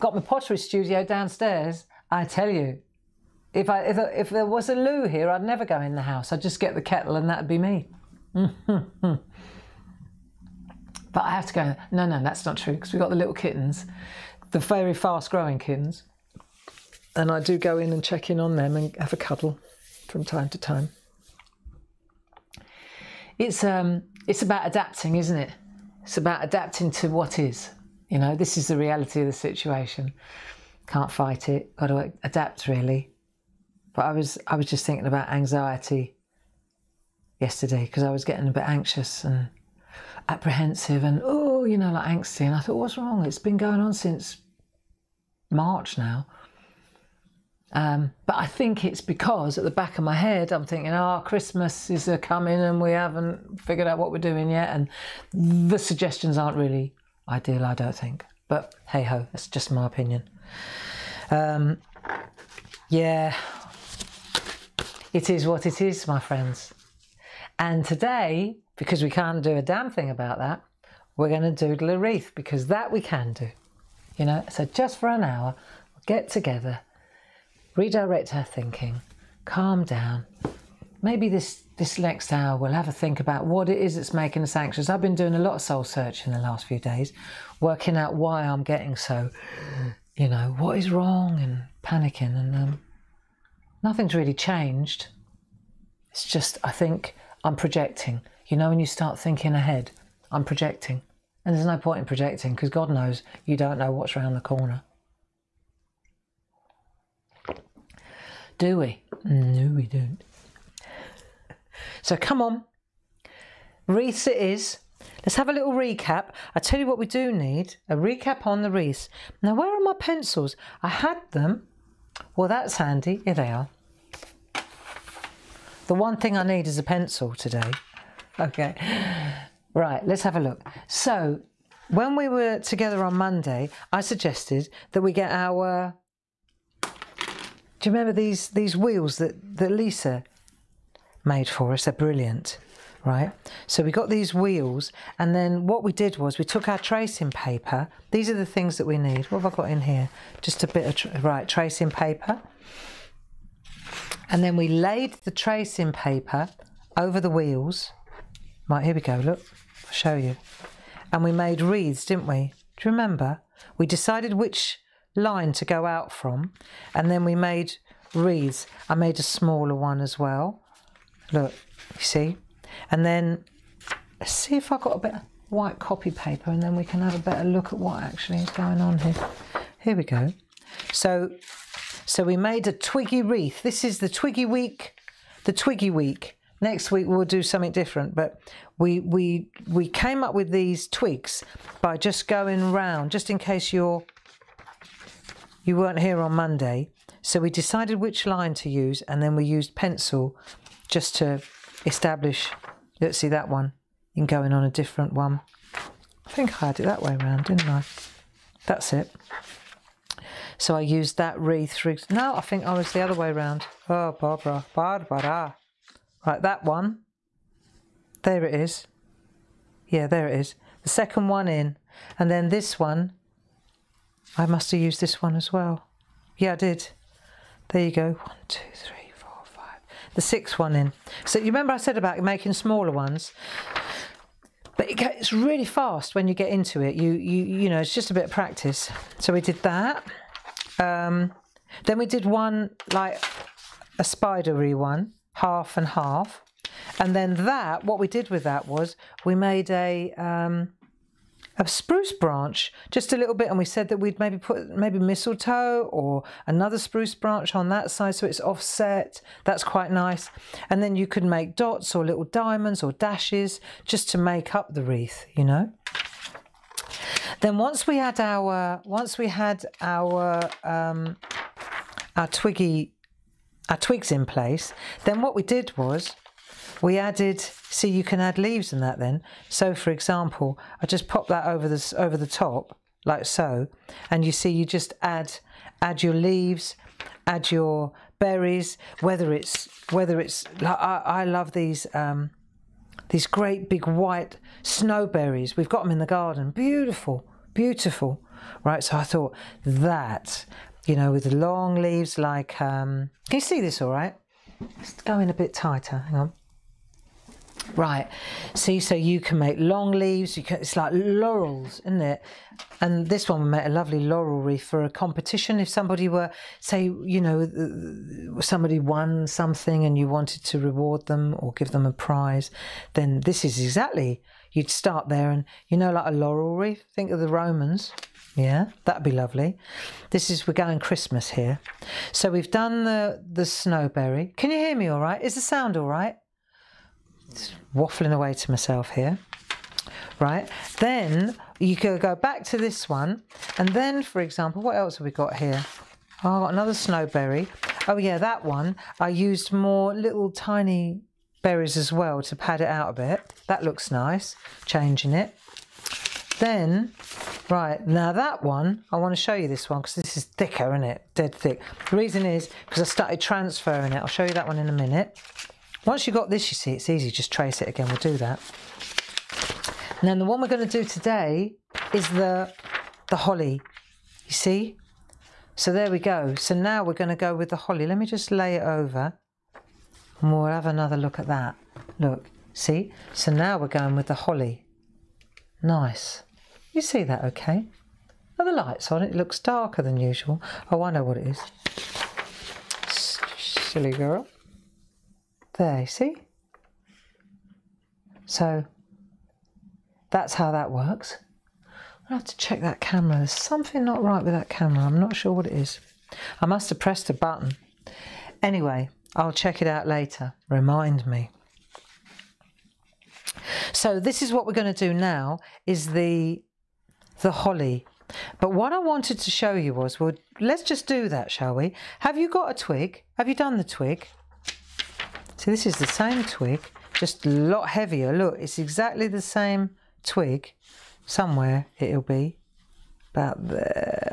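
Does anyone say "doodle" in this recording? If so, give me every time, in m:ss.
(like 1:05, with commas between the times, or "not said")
1:11.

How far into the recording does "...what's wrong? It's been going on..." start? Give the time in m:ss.
0:42.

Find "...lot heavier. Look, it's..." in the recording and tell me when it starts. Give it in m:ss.
7:07.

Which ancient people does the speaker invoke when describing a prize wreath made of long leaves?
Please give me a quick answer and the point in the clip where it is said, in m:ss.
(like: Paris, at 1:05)
the Romans, at 5:27.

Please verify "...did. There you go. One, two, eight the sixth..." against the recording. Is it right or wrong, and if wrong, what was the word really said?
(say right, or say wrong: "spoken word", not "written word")
wrong: "three", not "eight".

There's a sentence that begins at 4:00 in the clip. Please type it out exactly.
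Um, then we did one like a spidery one, half and half.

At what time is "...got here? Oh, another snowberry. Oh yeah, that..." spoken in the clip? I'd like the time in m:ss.
5:45.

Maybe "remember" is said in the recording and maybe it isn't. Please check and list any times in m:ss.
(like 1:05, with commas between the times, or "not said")
2:17, 2:42, 3:51.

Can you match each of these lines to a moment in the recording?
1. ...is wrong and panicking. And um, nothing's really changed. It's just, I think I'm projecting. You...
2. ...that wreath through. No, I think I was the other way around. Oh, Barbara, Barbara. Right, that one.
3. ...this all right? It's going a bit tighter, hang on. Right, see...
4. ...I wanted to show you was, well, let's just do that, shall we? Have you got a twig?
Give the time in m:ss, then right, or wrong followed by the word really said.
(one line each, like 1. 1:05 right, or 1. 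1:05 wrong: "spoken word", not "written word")
1. 1:30 right
2. 3:31 right
3. 5:03 right
4. 6:58 right.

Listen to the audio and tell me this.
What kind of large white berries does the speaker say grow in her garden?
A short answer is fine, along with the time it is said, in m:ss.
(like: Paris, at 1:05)
snowberries, at 4:54.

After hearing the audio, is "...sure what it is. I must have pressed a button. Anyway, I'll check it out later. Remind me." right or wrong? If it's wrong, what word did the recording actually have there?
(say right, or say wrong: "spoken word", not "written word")
right.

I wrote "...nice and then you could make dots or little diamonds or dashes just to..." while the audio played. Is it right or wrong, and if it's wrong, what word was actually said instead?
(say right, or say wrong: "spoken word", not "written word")
right.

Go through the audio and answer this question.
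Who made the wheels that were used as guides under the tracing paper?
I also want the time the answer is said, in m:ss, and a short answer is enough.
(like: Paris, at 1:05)
Lisa, at 2:19.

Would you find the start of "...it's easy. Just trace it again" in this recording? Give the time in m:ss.
6:06.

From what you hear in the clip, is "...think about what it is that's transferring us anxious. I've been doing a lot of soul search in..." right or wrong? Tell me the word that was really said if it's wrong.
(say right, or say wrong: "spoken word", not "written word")
wrong: "making", not "transferring".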